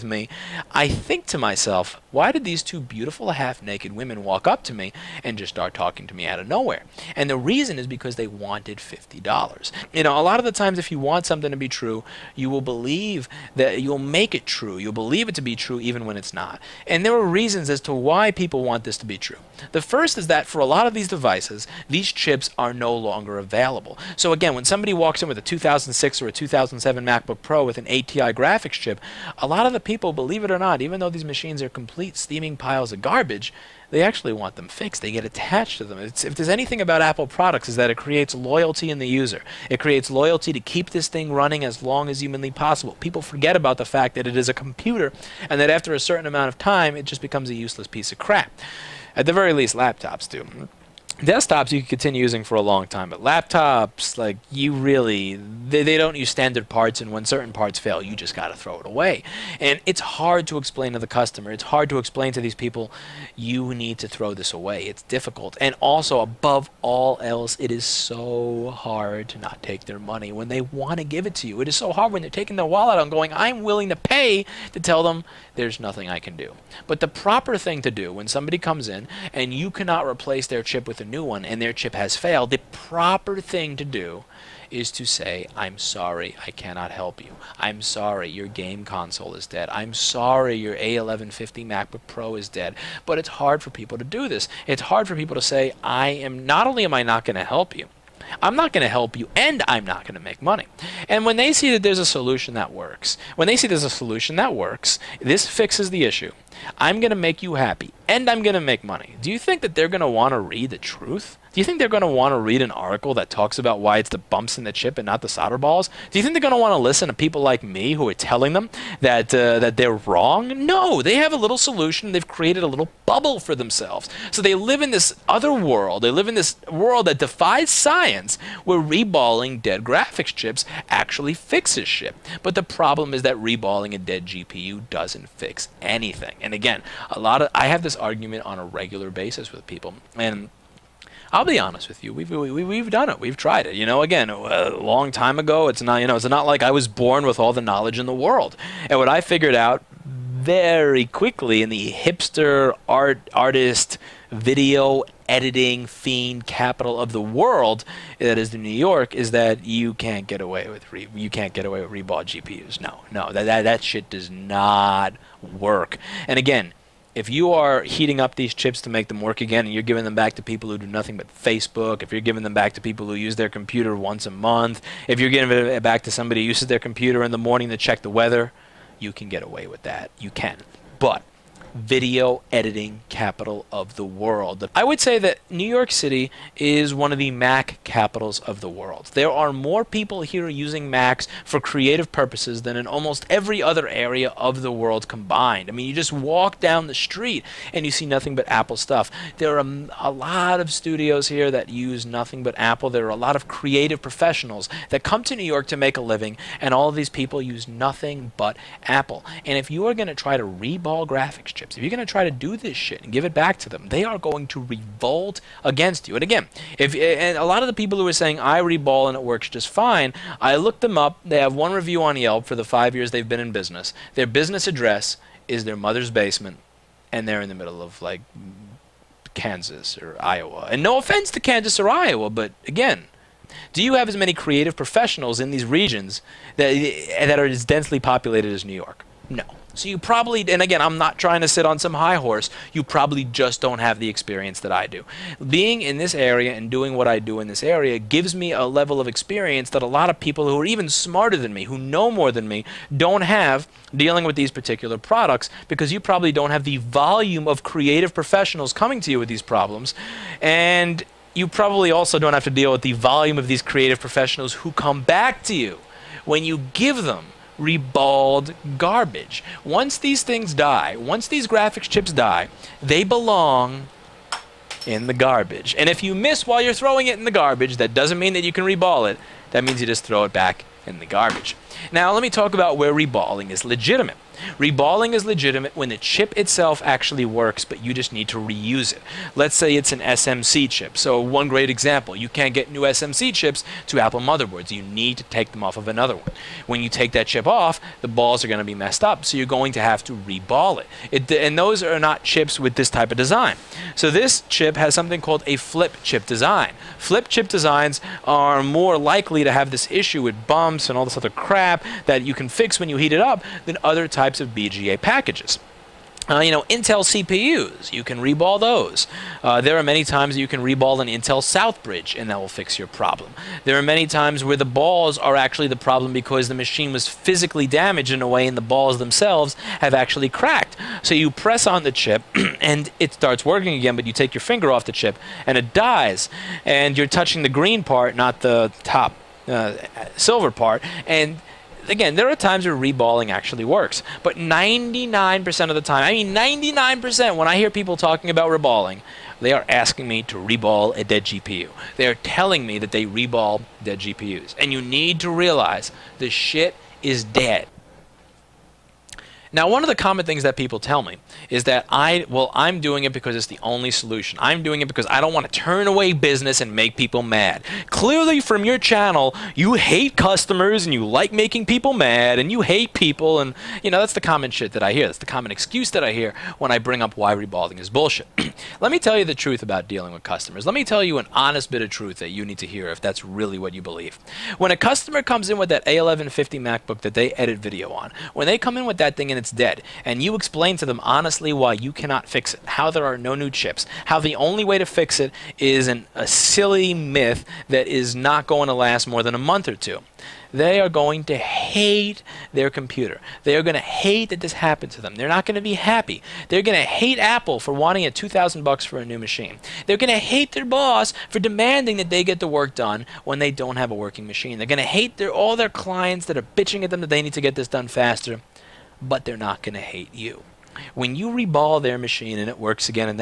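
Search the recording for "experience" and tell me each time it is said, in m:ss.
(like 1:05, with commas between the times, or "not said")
4:04, 4:09.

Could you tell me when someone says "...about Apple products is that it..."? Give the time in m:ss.
0:36.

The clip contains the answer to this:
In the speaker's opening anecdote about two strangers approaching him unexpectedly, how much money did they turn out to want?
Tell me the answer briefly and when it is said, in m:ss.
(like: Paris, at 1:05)
$50, at 0:08.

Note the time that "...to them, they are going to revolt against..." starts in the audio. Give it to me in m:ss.
3:33.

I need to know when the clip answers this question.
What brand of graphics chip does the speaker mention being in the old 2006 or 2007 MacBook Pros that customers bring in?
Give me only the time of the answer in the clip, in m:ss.
0:27.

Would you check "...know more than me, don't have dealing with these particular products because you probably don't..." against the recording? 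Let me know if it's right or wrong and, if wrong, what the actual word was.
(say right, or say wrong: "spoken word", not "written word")
right.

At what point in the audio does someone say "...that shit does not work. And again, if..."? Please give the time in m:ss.
2:43.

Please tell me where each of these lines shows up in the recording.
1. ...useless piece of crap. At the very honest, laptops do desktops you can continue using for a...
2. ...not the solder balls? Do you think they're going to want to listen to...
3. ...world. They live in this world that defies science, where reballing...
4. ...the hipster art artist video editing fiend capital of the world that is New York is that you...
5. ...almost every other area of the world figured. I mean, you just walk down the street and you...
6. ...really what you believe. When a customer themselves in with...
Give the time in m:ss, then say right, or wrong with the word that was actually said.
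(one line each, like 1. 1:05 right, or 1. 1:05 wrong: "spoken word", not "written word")
1. 0:47 wrong: "least", not "honest"
2. 1:55 right
3. 2:05 right
4. 2:31 right
5. 3:12 wrong: "combined", not "figured"
6. 6:23 wrong: "comes", not "themselves".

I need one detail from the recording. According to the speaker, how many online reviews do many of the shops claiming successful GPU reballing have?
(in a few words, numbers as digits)
1.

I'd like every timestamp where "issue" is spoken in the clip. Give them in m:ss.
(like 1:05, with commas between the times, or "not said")
1:46, 5:09.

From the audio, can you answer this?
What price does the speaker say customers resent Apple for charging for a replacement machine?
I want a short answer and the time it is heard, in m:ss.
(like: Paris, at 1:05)
$2000, at 6:48.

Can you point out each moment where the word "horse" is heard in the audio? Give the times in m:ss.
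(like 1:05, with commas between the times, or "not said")
4:02.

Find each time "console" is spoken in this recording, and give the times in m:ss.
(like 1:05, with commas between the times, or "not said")
1:28.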